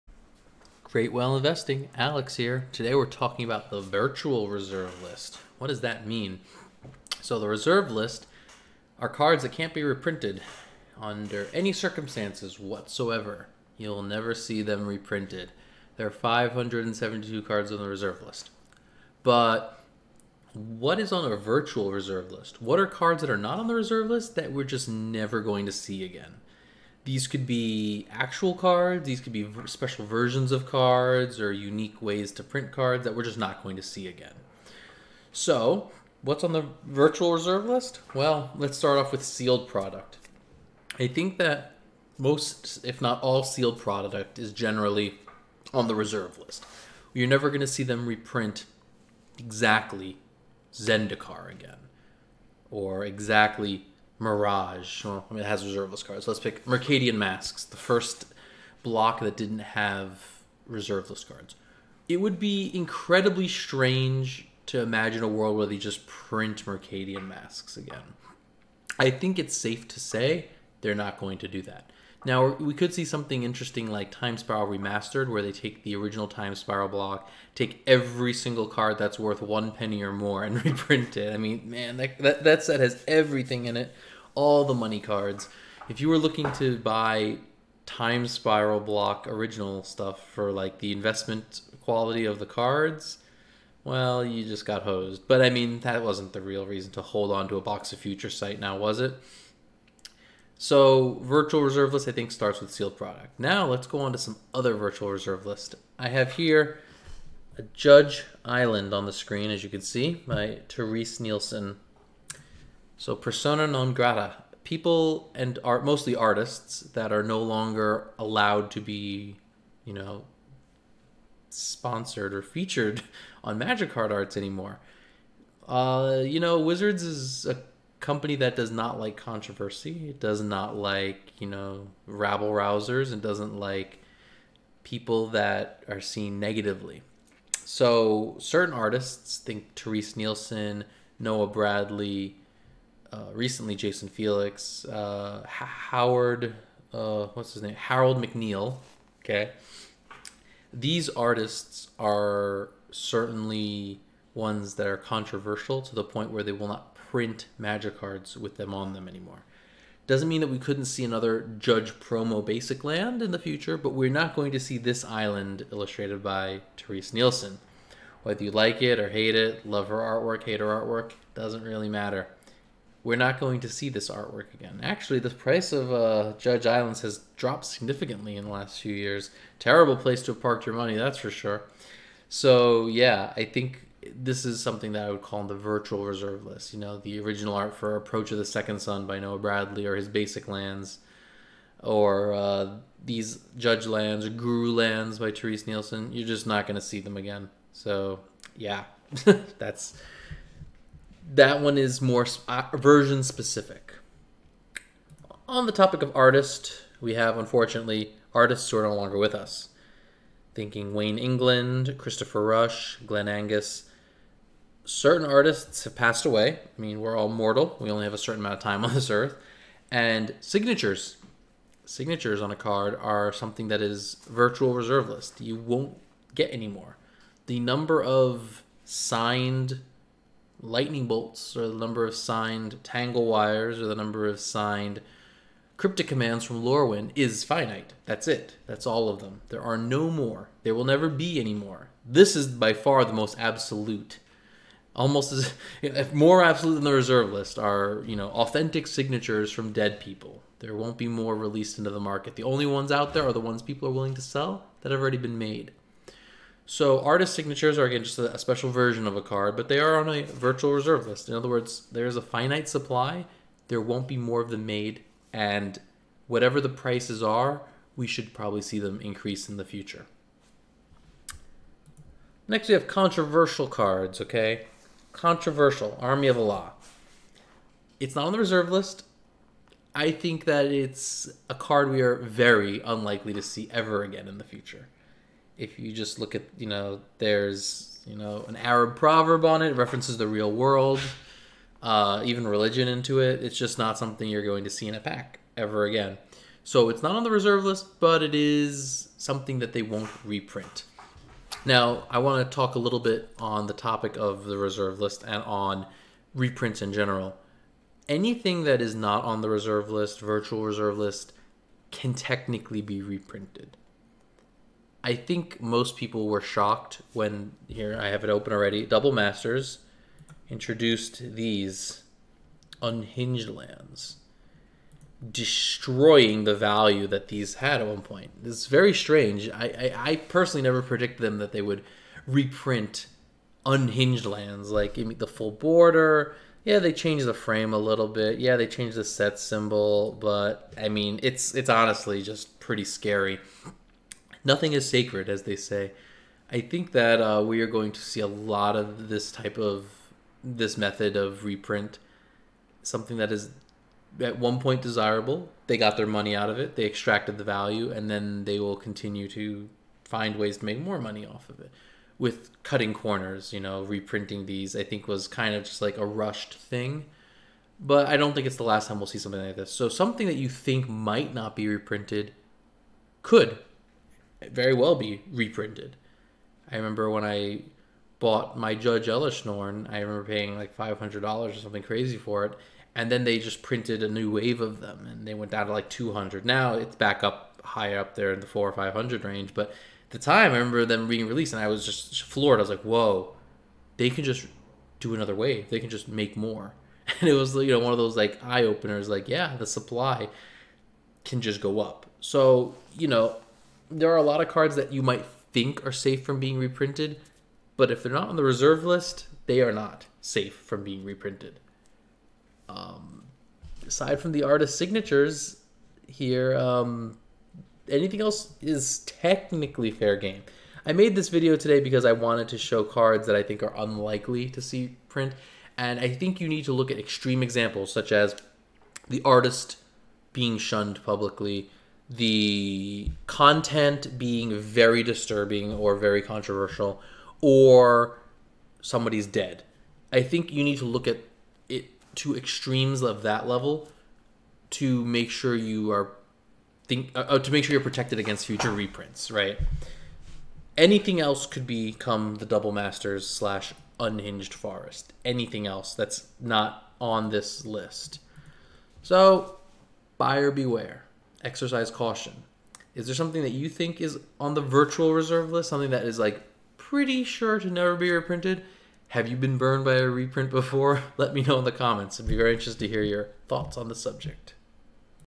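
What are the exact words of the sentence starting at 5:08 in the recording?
Anything that is not on the reserve list, virtual reserve list, can technically be reprinted.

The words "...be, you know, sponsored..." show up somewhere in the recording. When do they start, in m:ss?
1:58.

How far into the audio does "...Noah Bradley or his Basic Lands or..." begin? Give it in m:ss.
3:09.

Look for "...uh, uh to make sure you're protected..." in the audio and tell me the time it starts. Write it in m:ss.
7:27.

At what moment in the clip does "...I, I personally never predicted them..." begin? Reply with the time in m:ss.
5:30.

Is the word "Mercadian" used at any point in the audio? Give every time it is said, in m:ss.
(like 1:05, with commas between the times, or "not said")
0:56, 1:06.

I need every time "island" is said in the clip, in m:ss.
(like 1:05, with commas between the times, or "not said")
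1:48, 2:45, 2:56.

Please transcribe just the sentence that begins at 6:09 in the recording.
So something that you think might not be reprinted could very well be reprinted.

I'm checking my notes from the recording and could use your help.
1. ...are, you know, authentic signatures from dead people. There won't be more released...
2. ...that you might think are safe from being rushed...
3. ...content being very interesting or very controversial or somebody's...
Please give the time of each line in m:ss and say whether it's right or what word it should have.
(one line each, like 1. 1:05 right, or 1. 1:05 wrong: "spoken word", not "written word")
1. 4:07 right
2. 6:44 wrong: "reprinted", not "rushed"
3. 7:13 wrong: "disturbing", not "interesting".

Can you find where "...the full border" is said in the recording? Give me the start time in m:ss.
5:35.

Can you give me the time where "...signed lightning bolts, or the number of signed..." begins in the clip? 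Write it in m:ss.
3:48.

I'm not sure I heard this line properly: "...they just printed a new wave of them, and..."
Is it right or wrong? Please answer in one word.
right.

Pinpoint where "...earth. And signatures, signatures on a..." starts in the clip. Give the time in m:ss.
3:39.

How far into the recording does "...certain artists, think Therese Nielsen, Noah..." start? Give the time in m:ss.
2:18.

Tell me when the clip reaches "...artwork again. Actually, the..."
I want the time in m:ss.
2:54.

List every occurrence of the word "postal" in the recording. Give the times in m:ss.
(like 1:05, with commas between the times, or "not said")
not said.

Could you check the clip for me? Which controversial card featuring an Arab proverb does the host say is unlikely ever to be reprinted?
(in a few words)
Army of Allah.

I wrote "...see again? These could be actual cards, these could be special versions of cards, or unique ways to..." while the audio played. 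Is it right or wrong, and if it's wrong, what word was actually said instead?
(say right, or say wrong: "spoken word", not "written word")
right.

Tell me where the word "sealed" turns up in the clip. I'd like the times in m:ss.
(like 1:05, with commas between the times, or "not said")
0:39, 0:43, 1:42.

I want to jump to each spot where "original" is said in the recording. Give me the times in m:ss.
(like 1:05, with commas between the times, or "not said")
1:15, 1:29, 3:07.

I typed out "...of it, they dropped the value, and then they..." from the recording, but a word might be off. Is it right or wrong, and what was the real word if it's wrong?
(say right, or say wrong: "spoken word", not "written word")
wrong: "extracted", not "dropped".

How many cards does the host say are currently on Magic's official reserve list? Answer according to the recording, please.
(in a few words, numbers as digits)
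572.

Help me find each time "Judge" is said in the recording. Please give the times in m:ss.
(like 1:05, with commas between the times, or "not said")
1:47, 2:41, 2:56, 3:13, 6:18.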